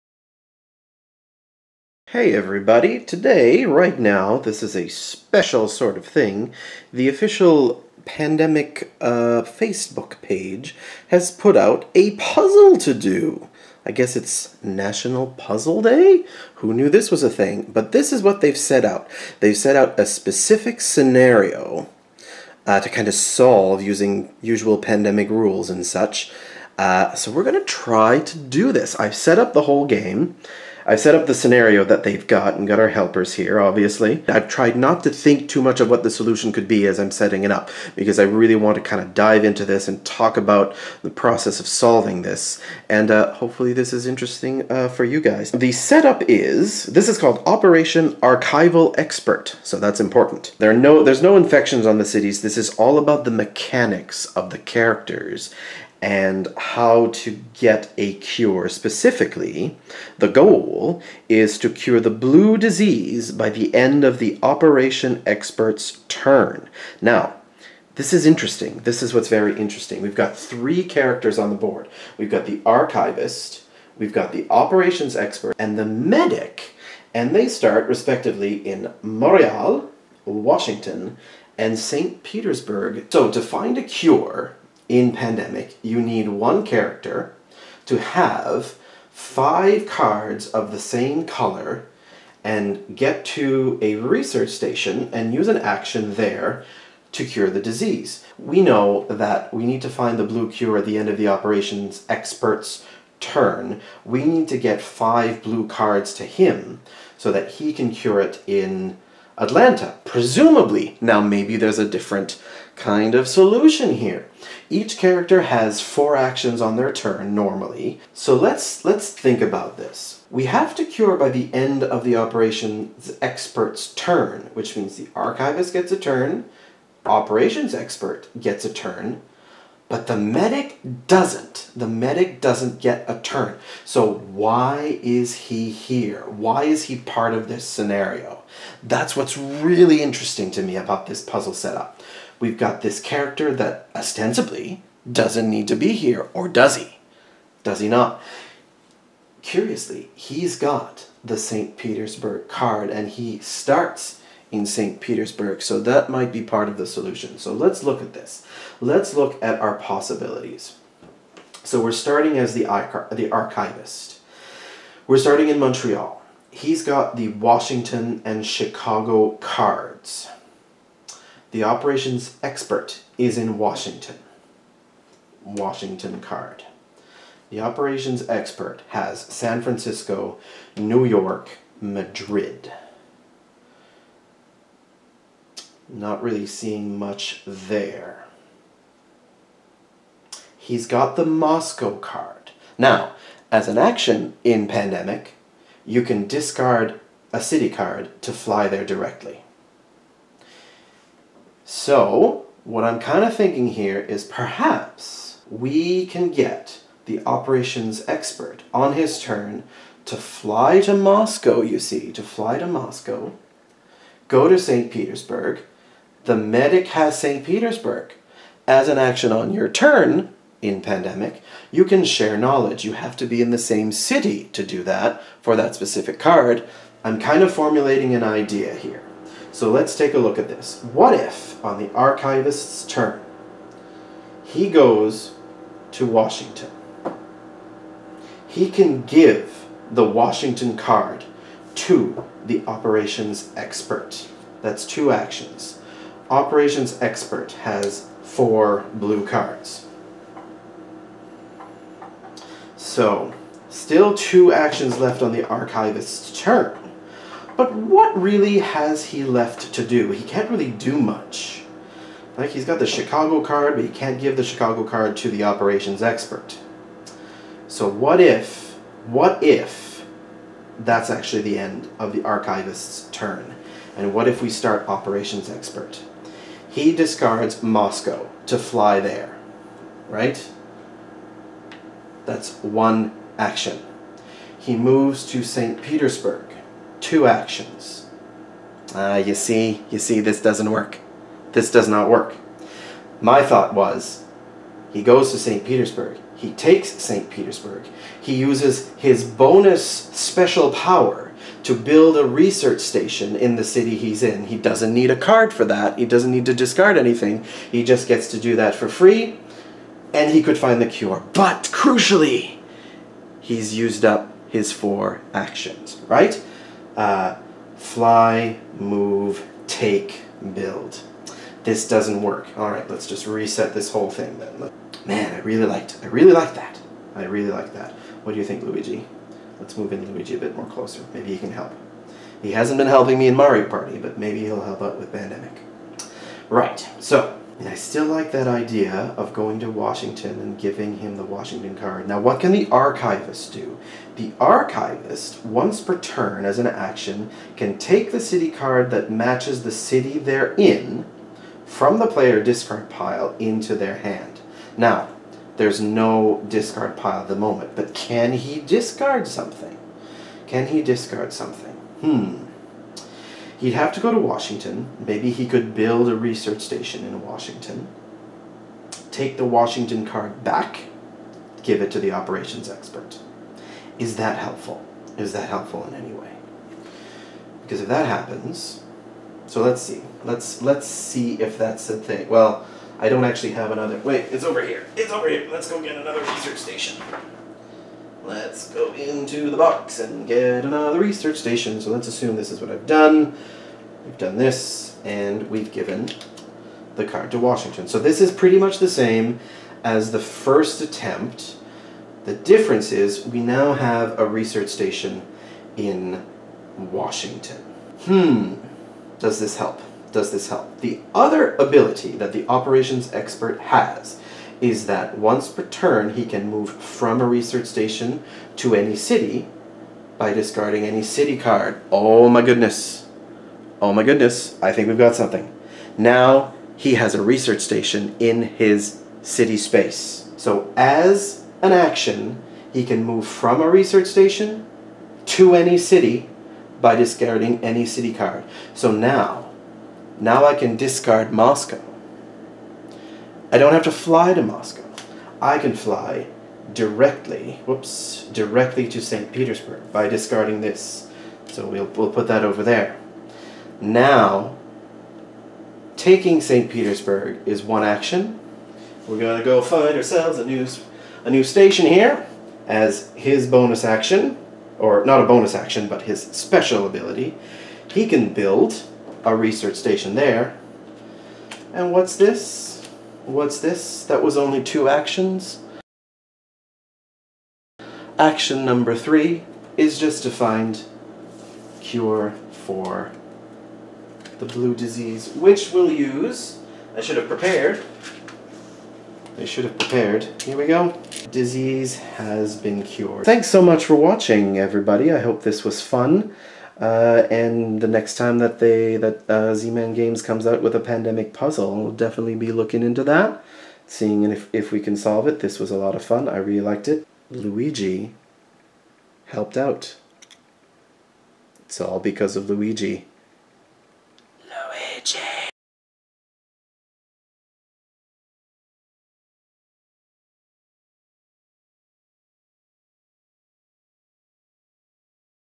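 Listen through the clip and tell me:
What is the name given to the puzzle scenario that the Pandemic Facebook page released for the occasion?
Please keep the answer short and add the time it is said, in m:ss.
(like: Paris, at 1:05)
Operation Archival Expert, at 0:47.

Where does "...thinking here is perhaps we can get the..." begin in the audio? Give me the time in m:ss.
3:23.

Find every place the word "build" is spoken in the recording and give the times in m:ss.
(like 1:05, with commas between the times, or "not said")
5:01, 5:20, 6:05, 7:48.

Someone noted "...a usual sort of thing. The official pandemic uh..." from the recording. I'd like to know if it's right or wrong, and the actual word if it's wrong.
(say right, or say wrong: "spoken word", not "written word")
wrong: "special", not "usual".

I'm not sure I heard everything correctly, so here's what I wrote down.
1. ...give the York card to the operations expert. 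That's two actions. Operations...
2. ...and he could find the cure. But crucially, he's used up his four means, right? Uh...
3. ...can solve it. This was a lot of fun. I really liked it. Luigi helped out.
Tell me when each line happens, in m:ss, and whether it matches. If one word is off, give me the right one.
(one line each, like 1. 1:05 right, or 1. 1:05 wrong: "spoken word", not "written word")
1. 3:59 wrong: "Washington", not "York"
2. 5:10 wrong: "actions", not "means"
3. 8:24 right.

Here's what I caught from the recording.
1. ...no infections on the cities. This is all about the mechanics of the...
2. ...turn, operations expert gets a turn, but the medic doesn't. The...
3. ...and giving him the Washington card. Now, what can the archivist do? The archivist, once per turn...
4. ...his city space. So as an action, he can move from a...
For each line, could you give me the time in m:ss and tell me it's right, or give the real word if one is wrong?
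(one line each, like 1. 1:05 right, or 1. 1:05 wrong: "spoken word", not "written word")
1. 0:51 right
2. 2:05 right
3. 5:40 right
4. 7:08 right.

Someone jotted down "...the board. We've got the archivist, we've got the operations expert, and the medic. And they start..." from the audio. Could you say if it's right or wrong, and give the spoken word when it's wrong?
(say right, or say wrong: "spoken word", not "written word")
right.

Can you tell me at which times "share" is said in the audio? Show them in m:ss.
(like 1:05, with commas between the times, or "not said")
3:42.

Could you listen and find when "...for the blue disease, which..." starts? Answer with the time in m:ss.
8:02.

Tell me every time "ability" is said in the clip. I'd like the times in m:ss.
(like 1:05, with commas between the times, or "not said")
6:51, 7:46.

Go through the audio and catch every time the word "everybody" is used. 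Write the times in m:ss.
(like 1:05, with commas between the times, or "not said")
0:02, 8:14.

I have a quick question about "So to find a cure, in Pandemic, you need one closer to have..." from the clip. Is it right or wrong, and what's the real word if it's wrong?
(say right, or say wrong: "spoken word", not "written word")
wrong: "character", not "closer".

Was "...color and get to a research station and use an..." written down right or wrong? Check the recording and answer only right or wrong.
right.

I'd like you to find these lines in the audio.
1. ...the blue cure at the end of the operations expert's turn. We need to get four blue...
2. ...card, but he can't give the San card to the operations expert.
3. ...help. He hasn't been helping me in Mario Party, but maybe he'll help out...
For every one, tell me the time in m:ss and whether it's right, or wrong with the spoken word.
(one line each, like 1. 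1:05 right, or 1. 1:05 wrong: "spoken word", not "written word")
1. 1:40 wrong: "five", not "four"
2. 4:23 wrong: "Chicago", not "San"
3. 5:31 right.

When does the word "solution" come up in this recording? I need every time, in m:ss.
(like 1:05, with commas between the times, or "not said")
0:36, 1:53, 2:36.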